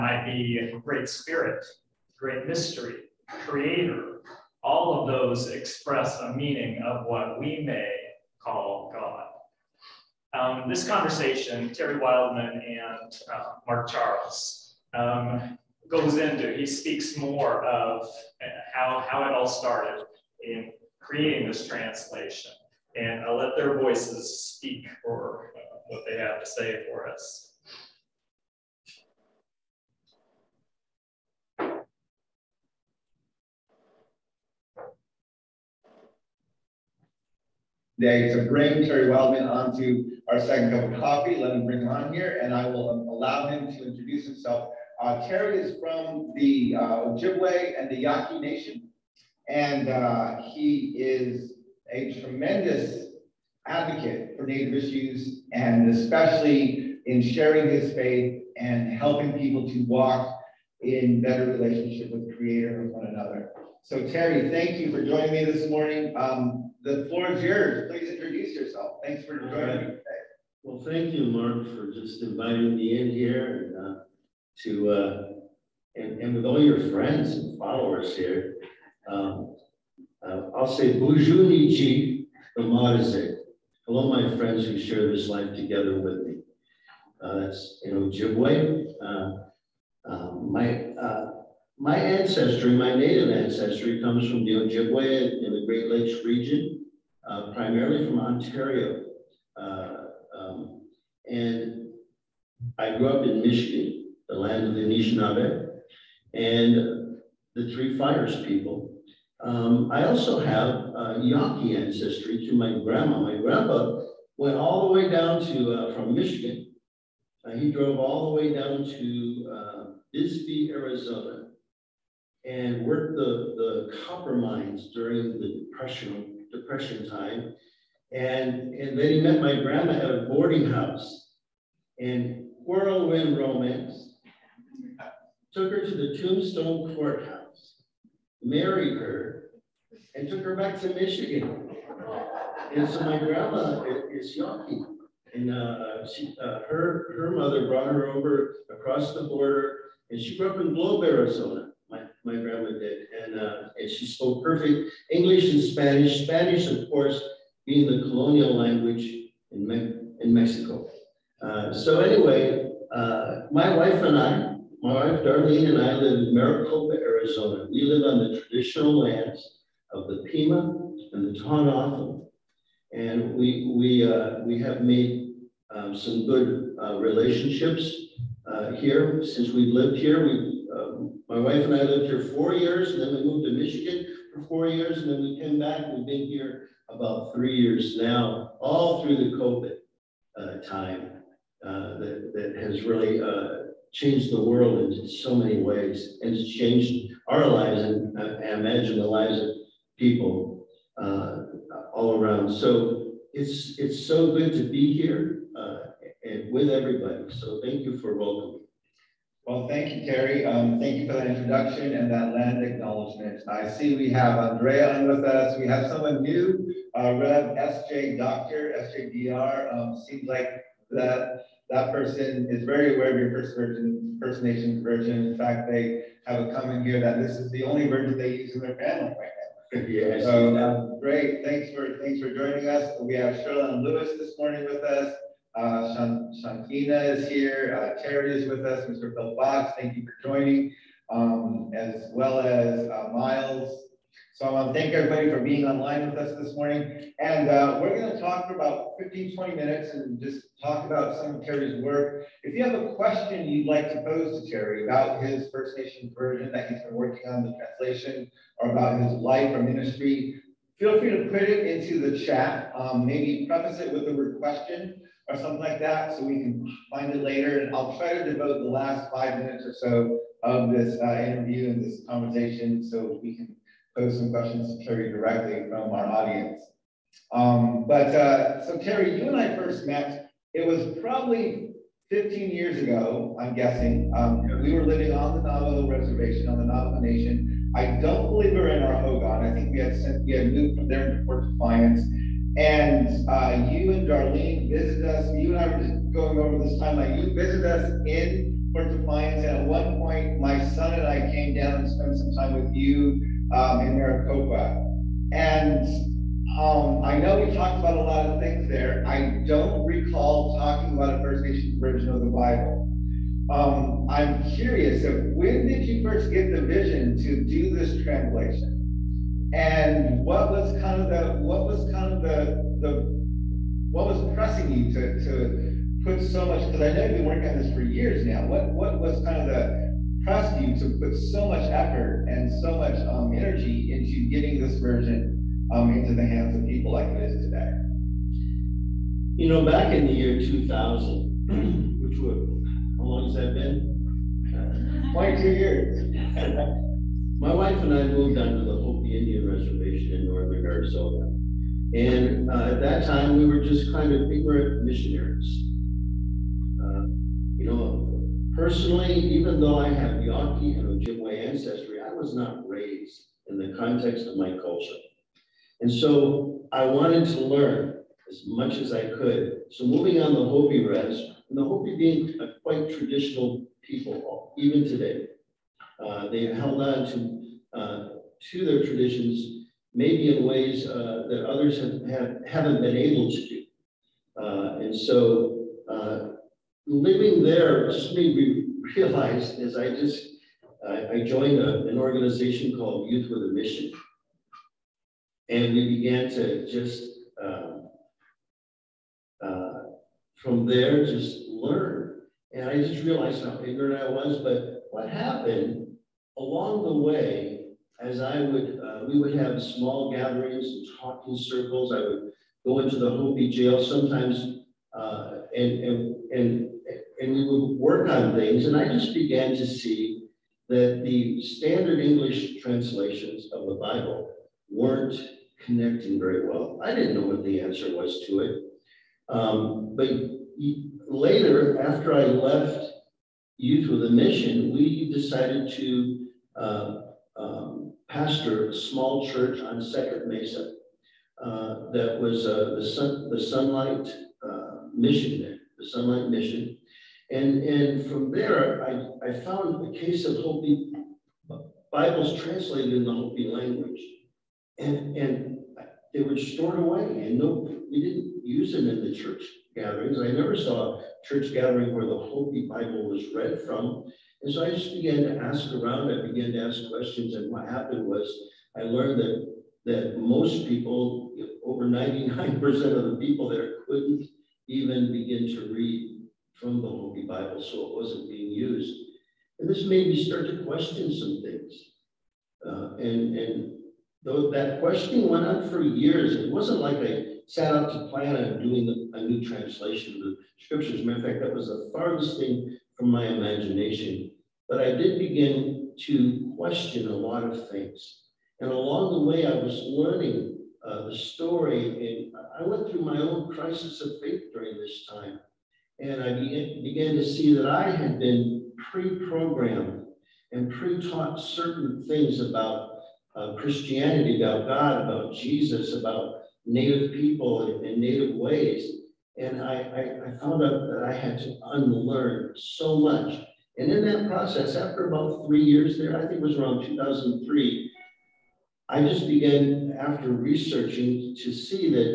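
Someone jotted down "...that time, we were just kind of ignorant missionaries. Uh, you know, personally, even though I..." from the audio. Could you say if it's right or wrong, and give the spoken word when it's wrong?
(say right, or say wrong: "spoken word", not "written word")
right.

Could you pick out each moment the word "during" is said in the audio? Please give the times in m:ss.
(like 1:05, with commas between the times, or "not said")
2:04, 8:24.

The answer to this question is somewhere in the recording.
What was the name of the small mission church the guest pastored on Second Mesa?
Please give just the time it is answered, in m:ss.
7:25.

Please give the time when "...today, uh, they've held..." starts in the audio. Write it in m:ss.
6:14.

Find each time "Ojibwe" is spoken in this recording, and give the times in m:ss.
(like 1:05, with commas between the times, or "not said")
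0:47, 1:28, 1:34, 6:01.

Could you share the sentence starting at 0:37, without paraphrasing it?
today to bring Terry Wildman onto our second cup of coffee.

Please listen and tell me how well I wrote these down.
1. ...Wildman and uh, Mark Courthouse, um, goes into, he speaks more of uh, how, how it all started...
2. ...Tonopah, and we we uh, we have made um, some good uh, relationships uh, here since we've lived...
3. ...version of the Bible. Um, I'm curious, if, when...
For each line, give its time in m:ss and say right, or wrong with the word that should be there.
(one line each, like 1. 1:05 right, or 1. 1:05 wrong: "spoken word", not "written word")
1. 0:11 wrong: "Charles", not "Courthouse"
2. 2:51 right
3. 5:11 right.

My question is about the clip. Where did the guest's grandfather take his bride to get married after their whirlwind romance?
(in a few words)
Tombstone Courthouse.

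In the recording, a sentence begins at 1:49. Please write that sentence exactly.
Um, I also have uh, Yaqui ancestry to my grandma.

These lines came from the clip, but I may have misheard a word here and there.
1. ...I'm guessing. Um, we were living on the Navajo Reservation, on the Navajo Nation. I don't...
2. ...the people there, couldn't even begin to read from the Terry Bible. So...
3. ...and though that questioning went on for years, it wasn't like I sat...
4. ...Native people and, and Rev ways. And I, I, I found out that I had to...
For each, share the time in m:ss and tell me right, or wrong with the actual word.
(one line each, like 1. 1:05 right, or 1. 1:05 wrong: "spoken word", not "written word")
1. 4:43 right
2. 7:53 wrong: "Hopi", not "Terry"
3. 8:03 right
4. 8:36 wrong: "Native", not "Rev".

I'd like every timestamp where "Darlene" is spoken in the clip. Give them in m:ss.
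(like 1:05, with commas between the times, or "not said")
2:45, 4:54.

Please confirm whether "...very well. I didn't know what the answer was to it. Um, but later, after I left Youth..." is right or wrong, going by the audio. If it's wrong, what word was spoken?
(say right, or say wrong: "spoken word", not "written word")
right.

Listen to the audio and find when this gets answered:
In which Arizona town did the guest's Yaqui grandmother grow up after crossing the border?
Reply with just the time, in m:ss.
2:30.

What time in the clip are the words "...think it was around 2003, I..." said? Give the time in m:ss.
8:46.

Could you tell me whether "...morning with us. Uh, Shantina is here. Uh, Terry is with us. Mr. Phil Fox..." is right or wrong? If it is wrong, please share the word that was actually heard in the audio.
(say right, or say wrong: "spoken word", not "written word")
right.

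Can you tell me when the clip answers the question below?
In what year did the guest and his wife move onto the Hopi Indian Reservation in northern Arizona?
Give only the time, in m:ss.
5:40.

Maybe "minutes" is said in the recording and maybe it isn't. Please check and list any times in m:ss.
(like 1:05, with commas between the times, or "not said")
4:09, 4:29.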